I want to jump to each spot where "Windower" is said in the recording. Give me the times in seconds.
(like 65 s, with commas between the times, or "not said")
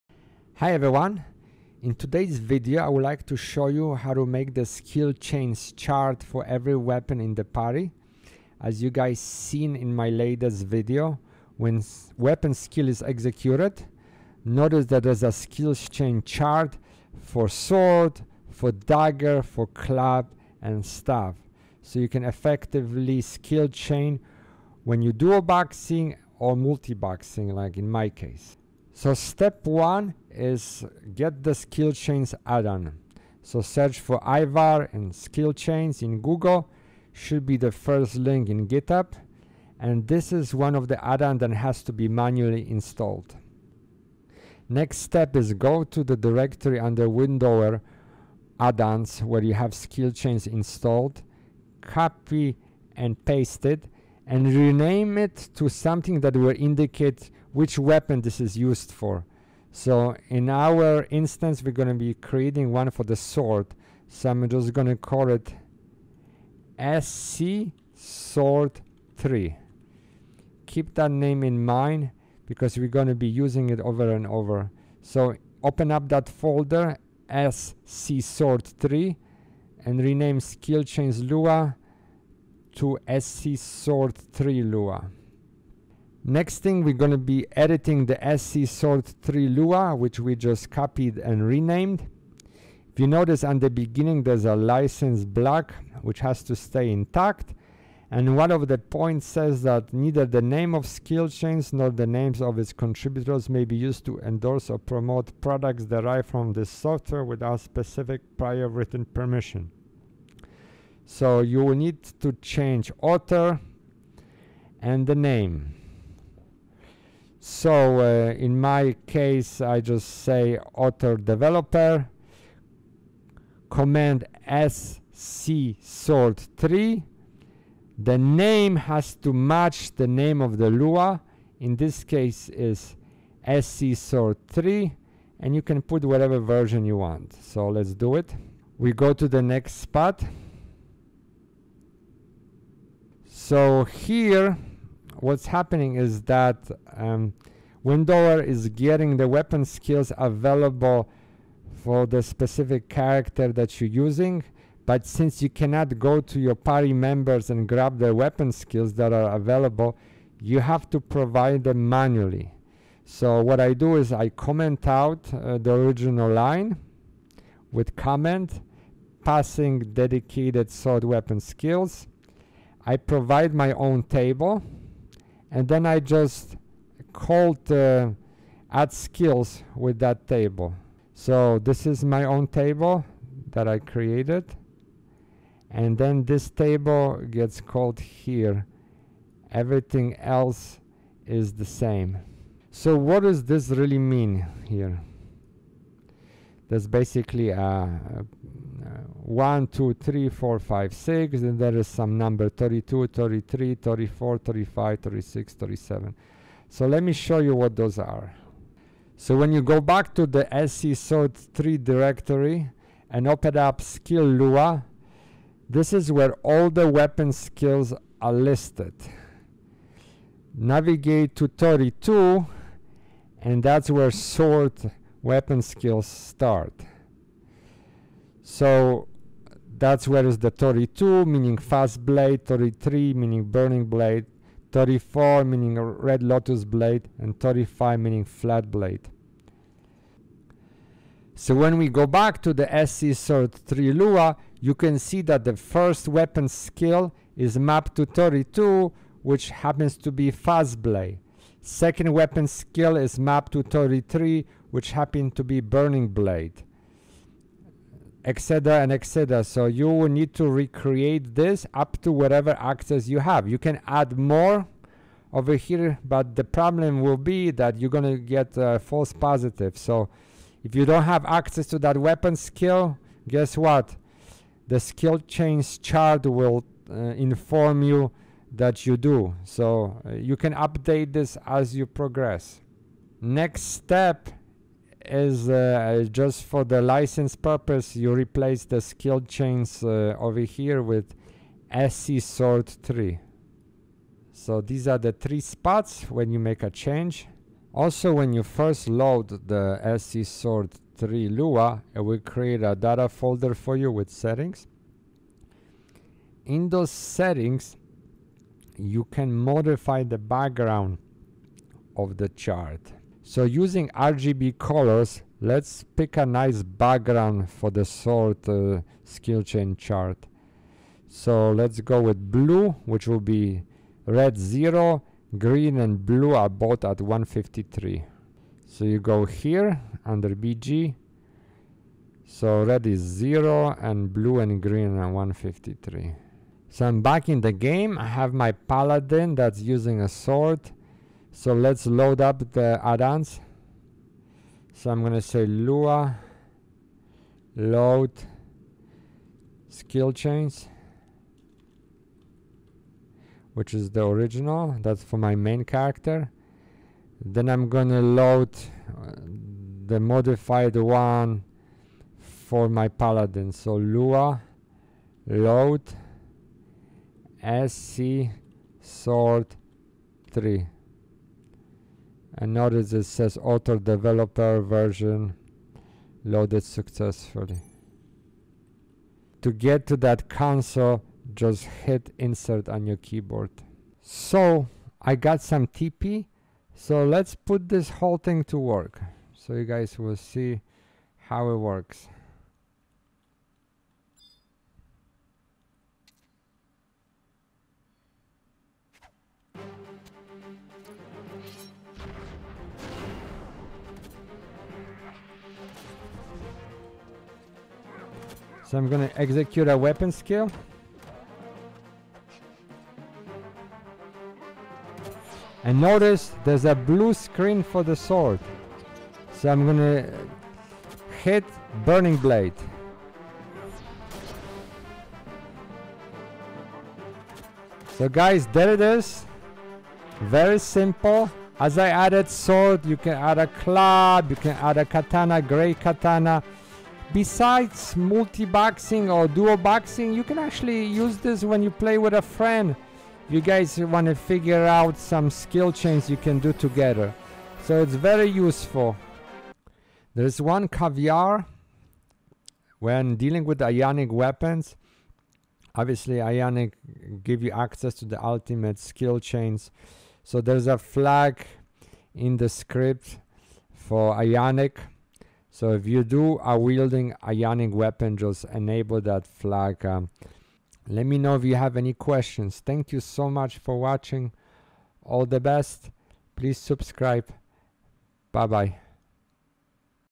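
47 s, 147 s.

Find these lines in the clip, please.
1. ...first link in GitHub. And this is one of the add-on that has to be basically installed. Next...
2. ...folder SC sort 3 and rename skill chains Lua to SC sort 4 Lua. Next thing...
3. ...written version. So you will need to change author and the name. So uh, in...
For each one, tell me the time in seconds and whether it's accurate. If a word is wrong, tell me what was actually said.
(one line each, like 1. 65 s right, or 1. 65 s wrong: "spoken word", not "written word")
1. 37 s wrong: "manually", not "basically"
2. 76 s wrong: "3", not "4"
3. 108 s wrong: "permission", not "version".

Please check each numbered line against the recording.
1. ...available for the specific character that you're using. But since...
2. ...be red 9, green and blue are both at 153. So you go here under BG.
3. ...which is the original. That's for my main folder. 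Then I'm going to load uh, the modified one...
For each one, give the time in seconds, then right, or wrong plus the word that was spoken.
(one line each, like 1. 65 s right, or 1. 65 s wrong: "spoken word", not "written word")
1. 150 s right
2. 323 s wrong: "0", not "9"
3. 353 s wrong: "character", not "folder".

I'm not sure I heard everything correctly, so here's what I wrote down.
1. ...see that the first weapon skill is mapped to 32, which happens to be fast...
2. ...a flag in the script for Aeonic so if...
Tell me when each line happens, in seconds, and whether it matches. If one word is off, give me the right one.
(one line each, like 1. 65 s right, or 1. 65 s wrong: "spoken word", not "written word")
1. 244 s right
2. 460 s right.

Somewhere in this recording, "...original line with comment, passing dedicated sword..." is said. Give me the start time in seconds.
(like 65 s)
165 s.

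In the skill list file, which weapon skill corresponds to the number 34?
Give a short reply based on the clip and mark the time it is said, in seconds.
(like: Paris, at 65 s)
Red Lotus Blade, at 235 s.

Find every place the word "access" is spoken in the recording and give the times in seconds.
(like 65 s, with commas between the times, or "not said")
262 s, 271 s, 457 s.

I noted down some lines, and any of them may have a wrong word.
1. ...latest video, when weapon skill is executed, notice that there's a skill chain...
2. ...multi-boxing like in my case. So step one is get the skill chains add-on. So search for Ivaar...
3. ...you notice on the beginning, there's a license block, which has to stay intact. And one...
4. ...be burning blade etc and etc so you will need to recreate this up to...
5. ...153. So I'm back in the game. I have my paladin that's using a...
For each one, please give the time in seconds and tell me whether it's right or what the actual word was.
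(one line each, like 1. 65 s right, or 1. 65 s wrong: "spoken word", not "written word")
1. 10 s right
2. 26 s right
3. 92 s right
4. 255 s right
5. 335 s right.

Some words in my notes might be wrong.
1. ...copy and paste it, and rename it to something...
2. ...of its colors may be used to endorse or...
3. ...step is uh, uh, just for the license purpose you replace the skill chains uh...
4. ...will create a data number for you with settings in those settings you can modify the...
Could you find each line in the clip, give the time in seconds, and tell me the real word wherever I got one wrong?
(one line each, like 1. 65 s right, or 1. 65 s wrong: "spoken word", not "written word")
1. 51 s right
2. 102 s wrong: "contributors", not "colors"
3. 283 s right
4. 302 s wrong: "folder", not "number".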